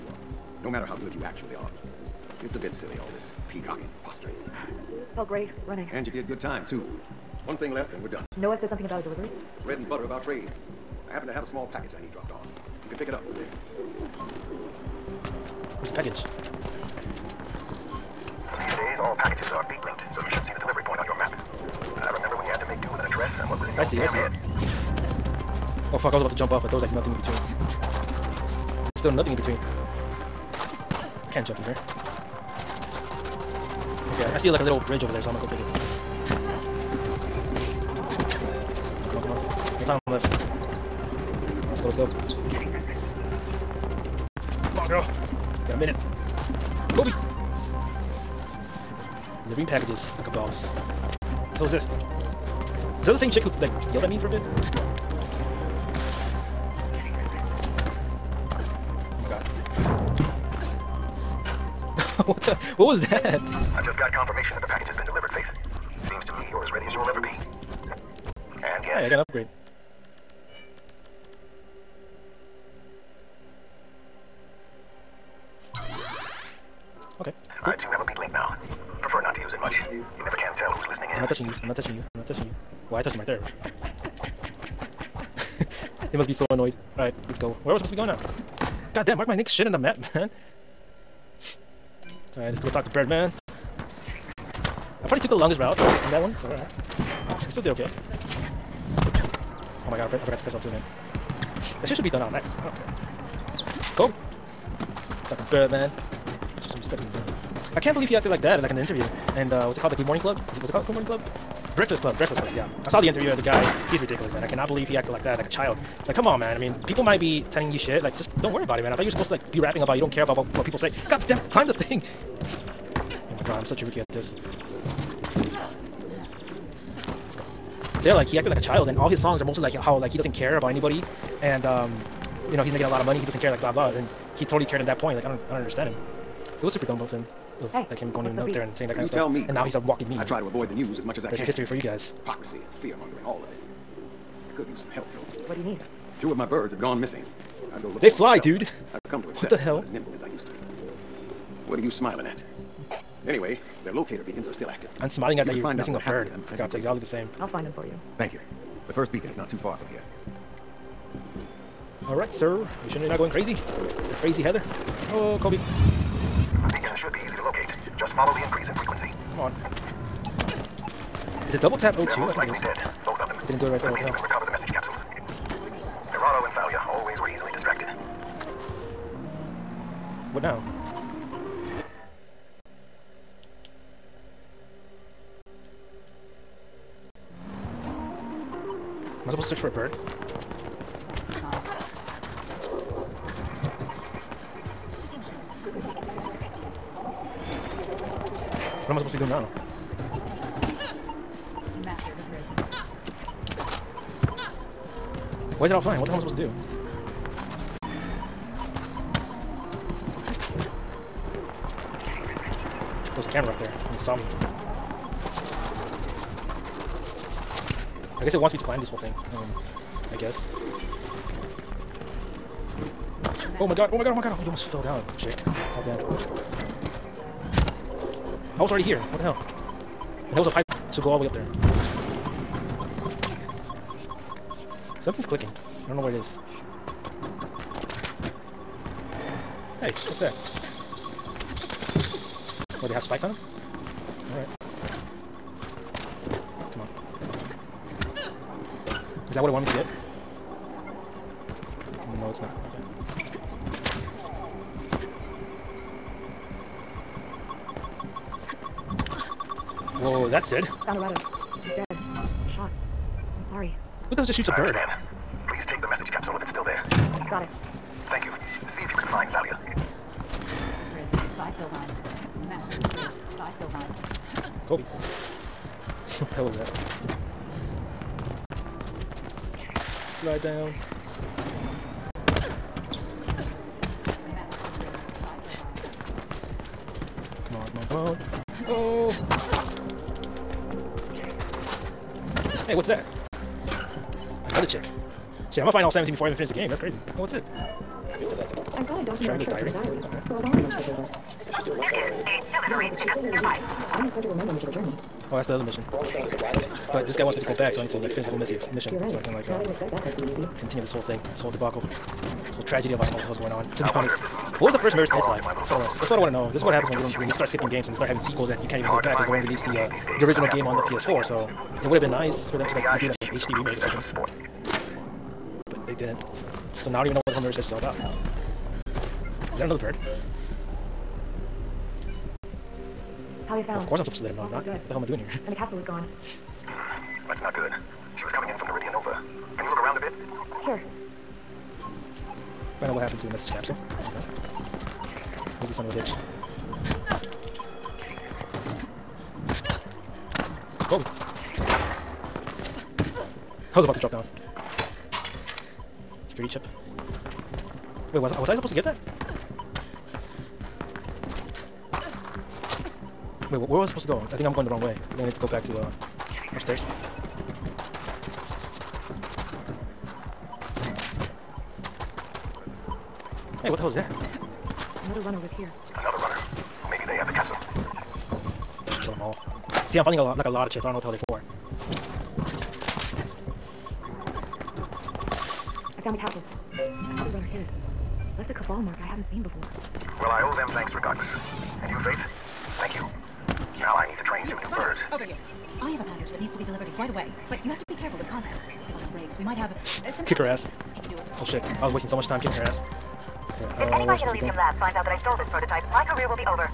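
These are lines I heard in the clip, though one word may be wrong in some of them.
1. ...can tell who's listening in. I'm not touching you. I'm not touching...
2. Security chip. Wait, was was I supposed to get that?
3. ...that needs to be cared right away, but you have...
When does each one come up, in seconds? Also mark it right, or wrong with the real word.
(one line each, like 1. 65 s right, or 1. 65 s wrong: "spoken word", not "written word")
1. 80 s right
2. 356 s right
3. 396 s wrong: "delivered", not "cared".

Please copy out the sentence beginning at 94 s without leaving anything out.
I probably took the longest route on that one, alright.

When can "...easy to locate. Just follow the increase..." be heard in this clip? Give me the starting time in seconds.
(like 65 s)
167 s.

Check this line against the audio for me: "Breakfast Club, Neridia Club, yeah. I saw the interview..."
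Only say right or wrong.
wrong.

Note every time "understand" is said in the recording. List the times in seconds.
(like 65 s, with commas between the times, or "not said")
135 s, 264 s.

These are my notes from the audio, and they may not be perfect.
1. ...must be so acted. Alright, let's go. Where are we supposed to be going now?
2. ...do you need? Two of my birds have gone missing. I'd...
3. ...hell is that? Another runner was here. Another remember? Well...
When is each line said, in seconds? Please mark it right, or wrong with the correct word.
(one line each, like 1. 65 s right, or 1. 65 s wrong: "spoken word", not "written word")
1. 86 s wrong: "annoyed", not "acted"
2. 145 s right
3. 373 s wrong: "runner", not "remember".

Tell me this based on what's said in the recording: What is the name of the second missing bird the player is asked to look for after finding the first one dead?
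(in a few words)
Thalia.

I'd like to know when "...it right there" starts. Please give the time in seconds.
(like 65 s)
173 s.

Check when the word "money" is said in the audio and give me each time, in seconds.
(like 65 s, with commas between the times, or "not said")
133 s.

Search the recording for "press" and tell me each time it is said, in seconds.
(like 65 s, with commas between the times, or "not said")
100 s.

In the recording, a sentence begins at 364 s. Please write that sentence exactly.
I think I'm going the wrong way.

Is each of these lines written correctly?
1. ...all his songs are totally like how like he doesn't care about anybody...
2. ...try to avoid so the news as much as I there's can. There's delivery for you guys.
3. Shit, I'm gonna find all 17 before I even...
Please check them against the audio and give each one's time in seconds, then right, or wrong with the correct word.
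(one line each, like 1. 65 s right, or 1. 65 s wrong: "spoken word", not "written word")
1. 128 s wrong: "mostly", not "totally"
2. 140 s wrong: "history", not "delivery"
3. 295 s right.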